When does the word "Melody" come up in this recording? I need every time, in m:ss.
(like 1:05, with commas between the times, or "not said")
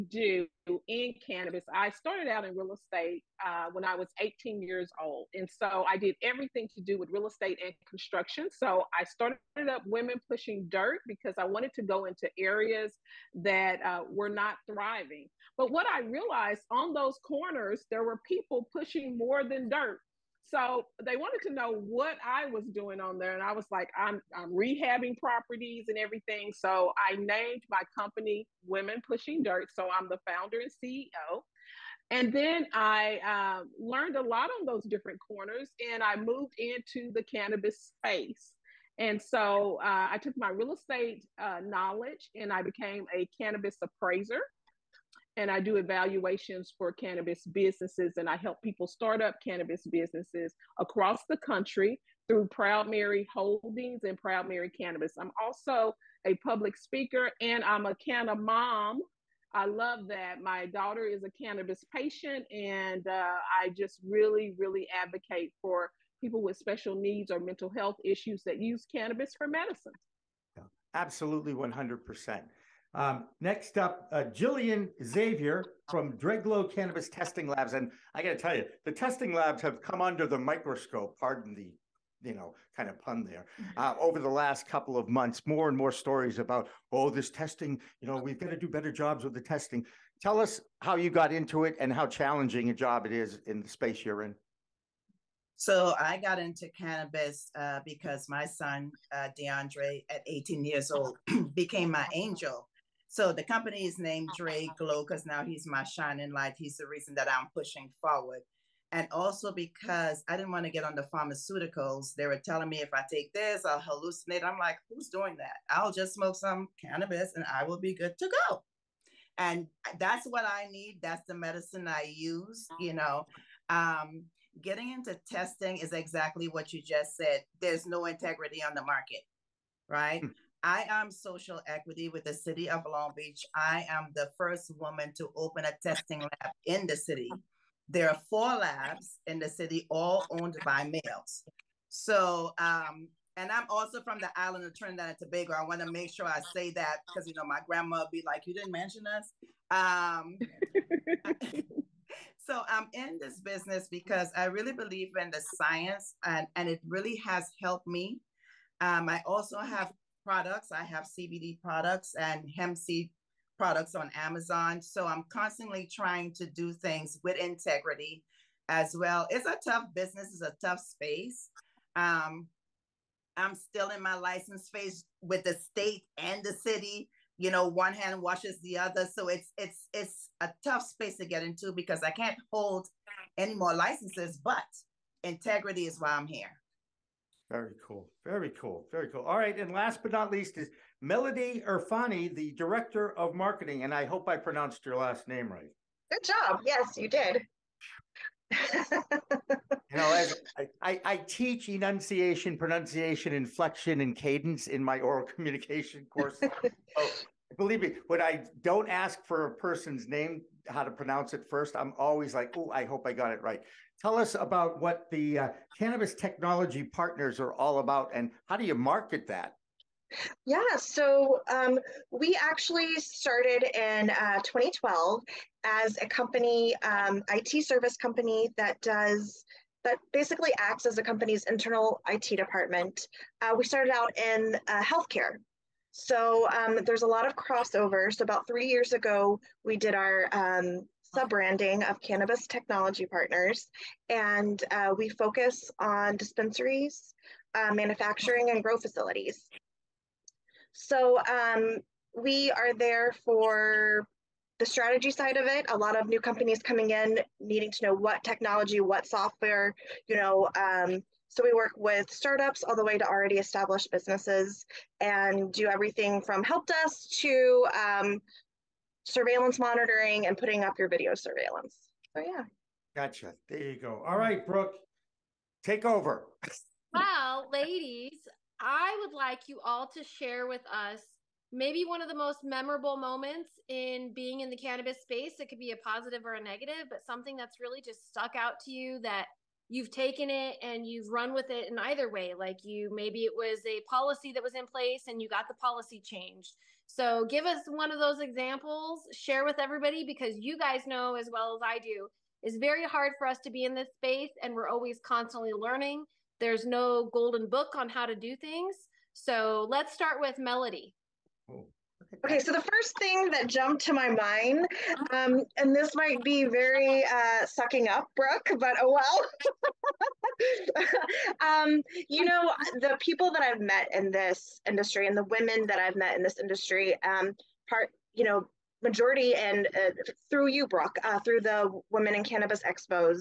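3:11, 5:10.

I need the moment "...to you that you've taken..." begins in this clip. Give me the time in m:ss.
4:48.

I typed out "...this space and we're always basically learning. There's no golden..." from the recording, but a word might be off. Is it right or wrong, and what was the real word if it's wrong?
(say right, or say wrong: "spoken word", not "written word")
wrong: "constantly", not "basically".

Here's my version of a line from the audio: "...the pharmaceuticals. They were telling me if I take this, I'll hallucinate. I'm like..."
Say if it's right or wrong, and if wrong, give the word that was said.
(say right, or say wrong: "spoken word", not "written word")
right.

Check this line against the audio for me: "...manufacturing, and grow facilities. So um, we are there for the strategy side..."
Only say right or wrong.
right.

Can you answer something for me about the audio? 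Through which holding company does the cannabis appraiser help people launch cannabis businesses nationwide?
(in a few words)
Proud Mary Holdings.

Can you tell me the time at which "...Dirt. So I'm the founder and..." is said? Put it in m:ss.
0:29.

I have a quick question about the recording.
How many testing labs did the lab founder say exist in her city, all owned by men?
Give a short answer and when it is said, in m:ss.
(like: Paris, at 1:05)
4, at 2:18.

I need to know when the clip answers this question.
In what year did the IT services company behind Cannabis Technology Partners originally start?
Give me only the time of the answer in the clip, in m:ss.
3:44.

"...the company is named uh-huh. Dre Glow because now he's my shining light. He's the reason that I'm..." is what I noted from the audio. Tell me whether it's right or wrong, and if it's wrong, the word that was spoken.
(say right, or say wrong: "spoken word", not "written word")
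right.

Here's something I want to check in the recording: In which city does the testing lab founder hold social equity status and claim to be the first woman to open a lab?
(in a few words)
Long Beach.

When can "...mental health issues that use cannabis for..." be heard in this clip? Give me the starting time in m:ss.
1:07.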